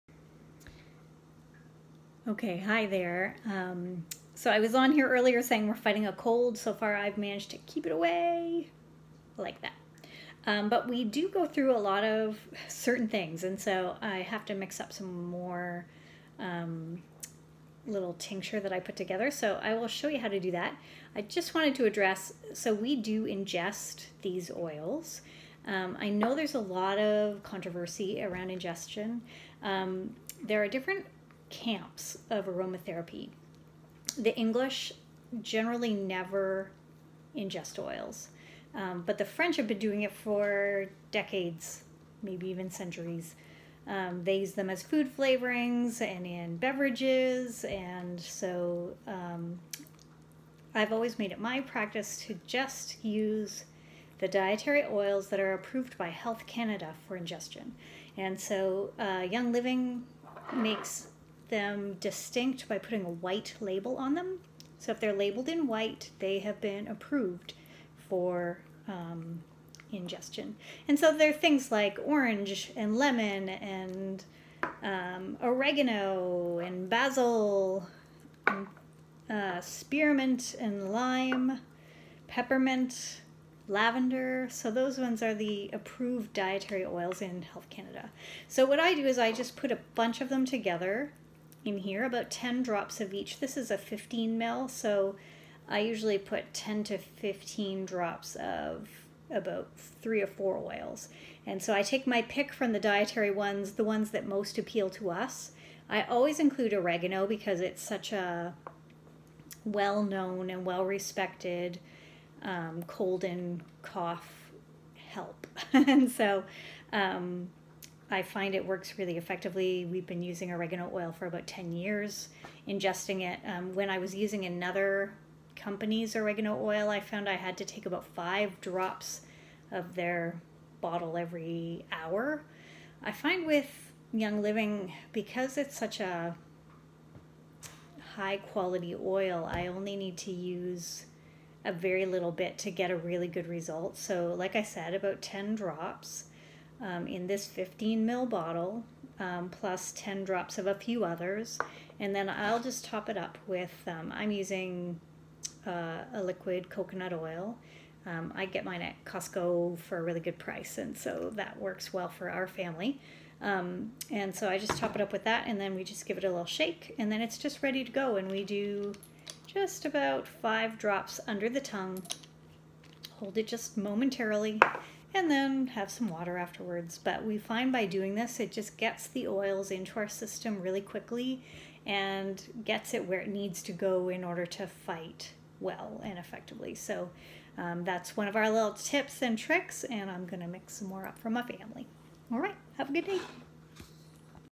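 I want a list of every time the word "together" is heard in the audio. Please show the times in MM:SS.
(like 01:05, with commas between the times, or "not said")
00:18, 01:30.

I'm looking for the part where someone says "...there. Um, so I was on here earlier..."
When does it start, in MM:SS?
00:02.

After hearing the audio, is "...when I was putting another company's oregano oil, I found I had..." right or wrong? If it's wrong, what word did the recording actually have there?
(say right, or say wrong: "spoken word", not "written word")
wrong: "using", not "putting".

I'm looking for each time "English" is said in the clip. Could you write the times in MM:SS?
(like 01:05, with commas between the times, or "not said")
00:34.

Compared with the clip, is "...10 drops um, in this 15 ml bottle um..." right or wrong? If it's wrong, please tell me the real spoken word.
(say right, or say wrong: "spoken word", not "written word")
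right.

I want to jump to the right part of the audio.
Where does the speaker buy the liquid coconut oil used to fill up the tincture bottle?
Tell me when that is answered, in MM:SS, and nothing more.
02:39.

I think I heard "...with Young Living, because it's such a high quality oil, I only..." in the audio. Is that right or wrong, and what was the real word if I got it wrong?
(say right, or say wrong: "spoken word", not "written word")
right.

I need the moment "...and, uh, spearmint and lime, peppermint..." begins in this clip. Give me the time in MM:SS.
01:18.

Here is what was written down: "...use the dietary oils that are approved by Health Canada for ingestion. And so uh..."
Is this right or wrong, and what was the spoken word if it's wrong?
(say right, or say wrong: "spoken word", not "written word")
right.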